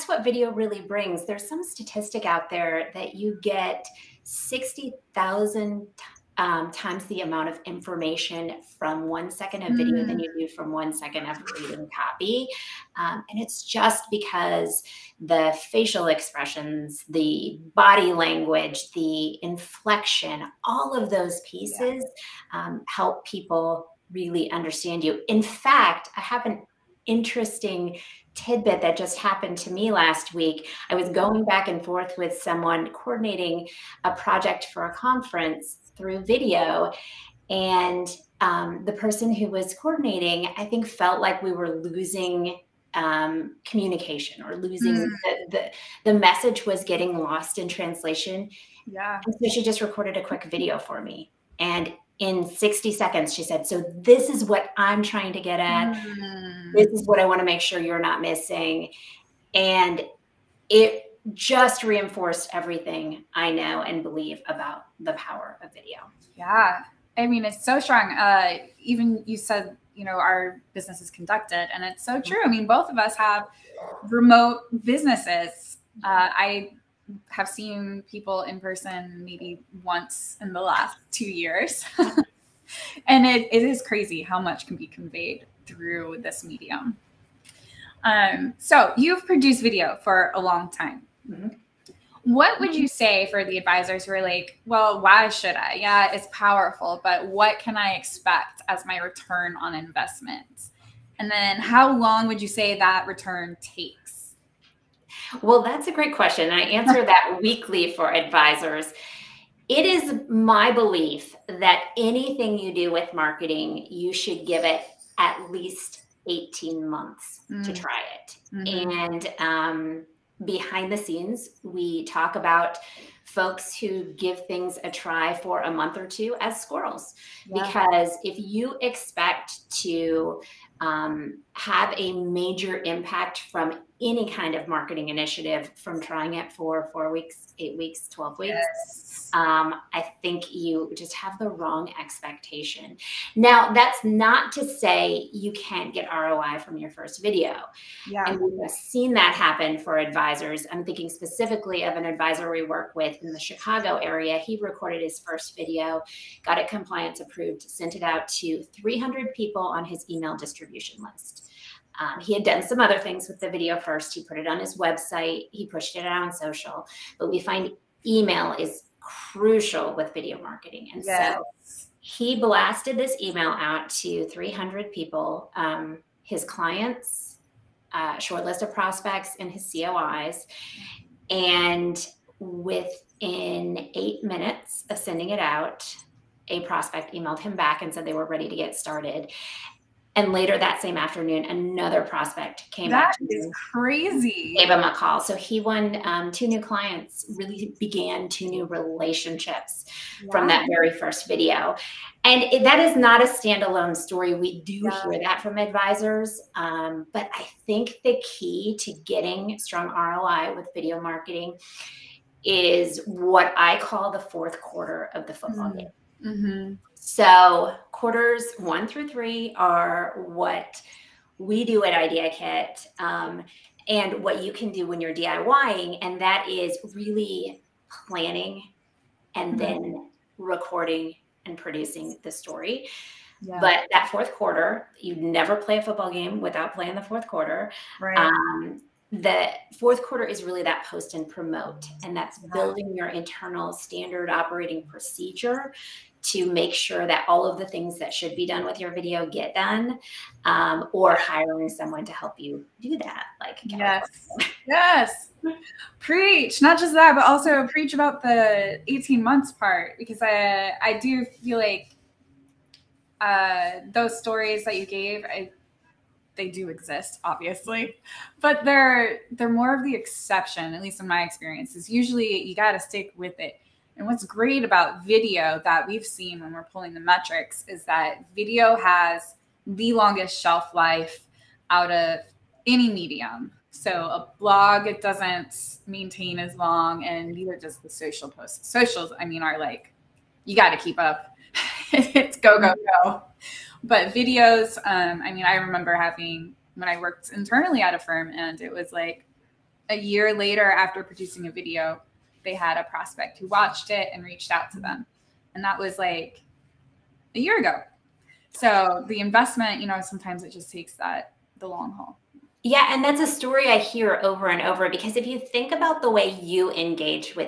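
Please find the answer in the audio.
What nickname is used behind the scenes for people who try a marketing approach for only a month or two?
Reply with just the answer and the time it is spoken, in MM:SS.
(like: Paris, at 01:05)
squirrels, at 02:06.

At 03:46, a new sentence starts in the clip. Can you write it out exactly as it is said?
And that is really planning and mm-hmm.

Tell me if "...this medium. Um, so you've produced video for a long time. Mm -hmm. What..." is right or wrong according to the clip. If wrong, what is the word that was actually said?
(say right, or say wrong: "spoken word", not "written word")
right.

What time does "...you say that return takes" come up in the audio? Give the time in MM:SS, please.
01:42.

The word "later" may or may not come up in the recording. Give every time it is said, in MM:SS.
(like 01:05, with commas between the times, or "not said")
03:10, 05:00.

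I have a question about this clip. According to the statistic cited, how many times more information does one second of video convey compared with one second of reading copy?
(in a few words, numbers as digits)
60,000.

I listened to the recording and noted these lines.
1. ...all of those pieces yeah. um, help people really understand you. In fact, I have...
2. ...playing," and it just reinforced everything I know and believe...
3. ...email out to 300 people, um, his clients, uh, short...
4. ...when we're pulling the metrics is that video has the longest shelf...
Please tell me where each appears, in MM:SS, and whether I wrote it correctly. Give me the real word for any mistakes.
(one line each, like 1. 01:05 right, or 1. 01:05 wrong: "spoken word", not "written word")
1. 00:20 right
2. 00:58 wrong: "missing", not "playing"
3. 02:53 right
4. 04:36 right.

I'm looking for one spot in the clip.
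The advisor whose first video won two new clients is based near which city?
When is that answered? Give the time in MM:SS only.
02:33.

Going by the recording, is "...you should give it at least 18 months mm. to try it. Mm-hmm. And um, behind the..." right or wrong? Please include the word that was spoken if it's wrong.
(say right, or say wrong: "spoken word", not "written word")
right.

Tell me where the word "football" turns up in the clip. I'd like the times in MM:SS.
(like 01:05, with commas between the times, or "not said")
03:35, 03:55.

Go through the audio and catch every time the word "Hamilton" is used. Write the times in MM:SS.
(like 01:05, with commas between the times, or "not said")
not said.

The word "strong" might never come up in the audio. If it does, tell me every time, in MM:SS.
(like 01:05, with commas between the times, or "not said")
01:07, 03:29.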